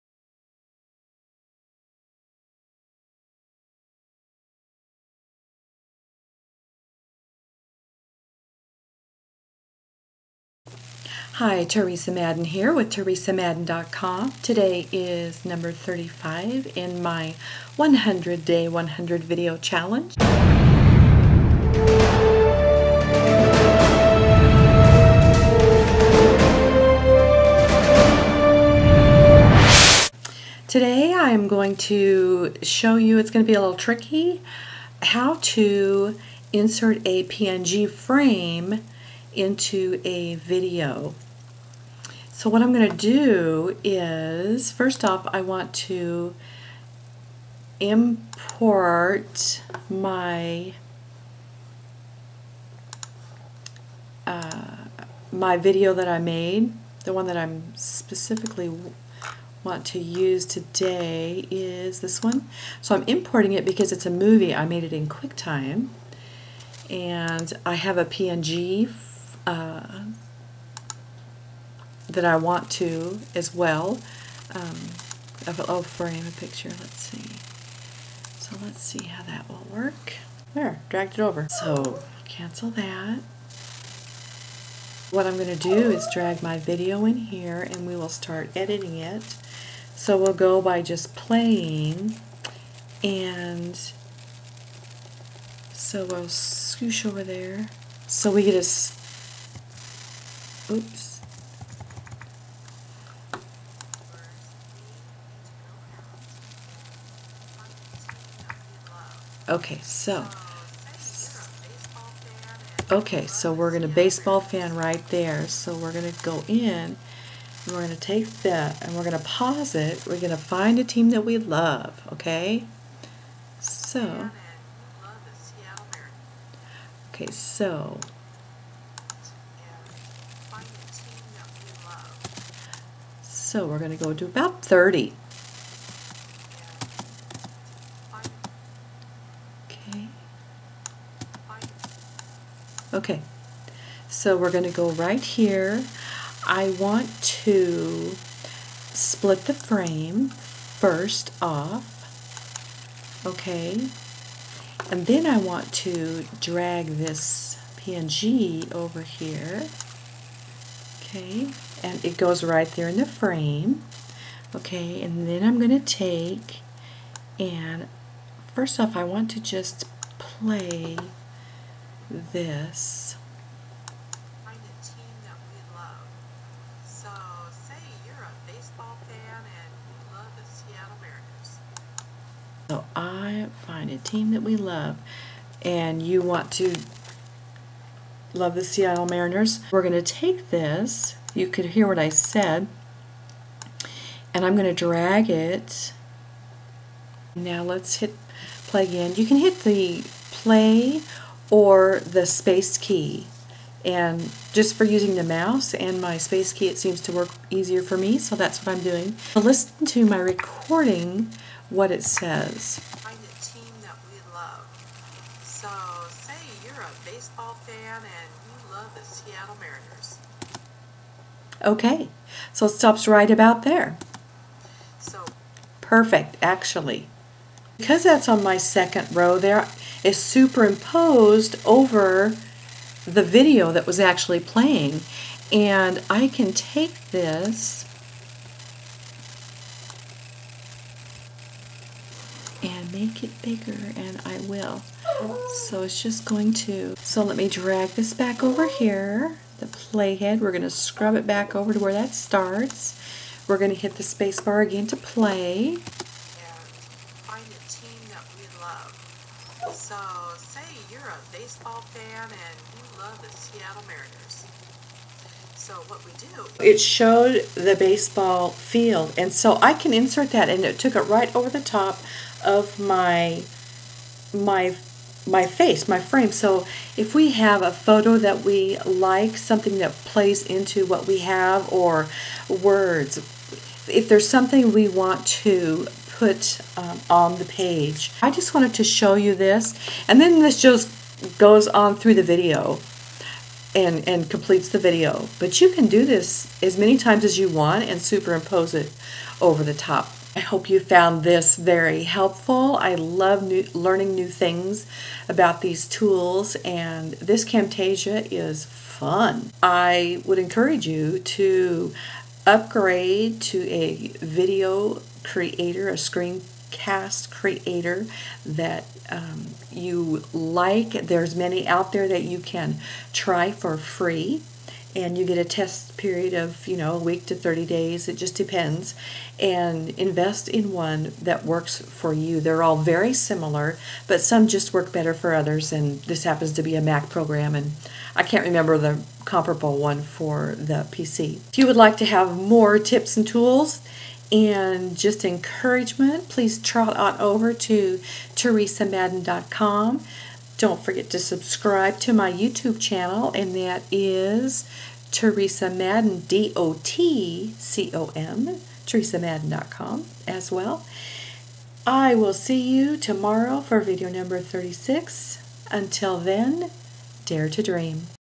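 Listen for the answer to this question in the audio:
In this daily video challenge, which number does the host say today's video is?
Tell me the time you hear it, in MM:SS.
00:15.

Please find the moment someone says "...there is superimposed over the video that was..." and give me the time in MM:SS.
03:49.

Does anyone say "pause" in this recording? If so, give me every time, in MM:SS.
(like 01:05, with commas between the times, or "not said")
01:59.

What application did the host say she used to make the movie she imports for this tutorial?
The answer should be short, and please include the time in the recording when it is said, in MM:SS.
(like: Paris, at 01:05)
QuickTime, at 01:05.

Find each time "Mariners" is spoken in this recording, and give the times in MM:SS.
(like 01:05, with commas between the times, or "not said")
03:09, 03:39, 04:23.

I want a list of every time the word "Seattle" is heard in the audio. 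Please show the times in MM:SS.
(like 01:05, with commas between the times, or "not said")
03:08, 03:39, 04:23.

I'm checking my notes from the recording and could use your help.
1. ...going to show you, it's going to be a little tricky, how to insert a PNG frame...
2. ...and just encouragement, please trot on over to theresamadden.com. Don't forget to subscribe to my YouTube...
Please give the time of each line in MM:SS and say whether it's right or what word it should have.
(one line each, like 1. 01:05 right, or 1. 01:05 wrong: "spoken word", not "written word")
1. 00:31 right
2. 05:44 right.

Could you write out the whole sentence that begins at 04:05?
So it's just going to, so let me drag this back over here, the playhead.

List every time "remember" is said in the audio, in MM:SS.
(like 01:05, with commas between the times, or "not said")
05:38.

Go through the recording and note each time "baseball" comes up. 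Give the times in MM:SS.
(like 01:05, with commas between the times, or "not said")
01:53, 03:37, 04:21, 04:27.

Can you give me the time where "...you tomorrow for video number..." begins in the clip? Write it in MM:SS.
06:02.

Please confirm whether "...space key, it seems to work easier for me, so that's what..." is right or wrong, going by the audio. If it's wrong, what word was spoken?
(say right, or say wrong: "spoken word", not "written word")
right.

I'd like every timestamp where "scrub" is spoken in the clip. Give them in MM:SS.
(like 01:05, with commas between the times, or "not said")
04:10.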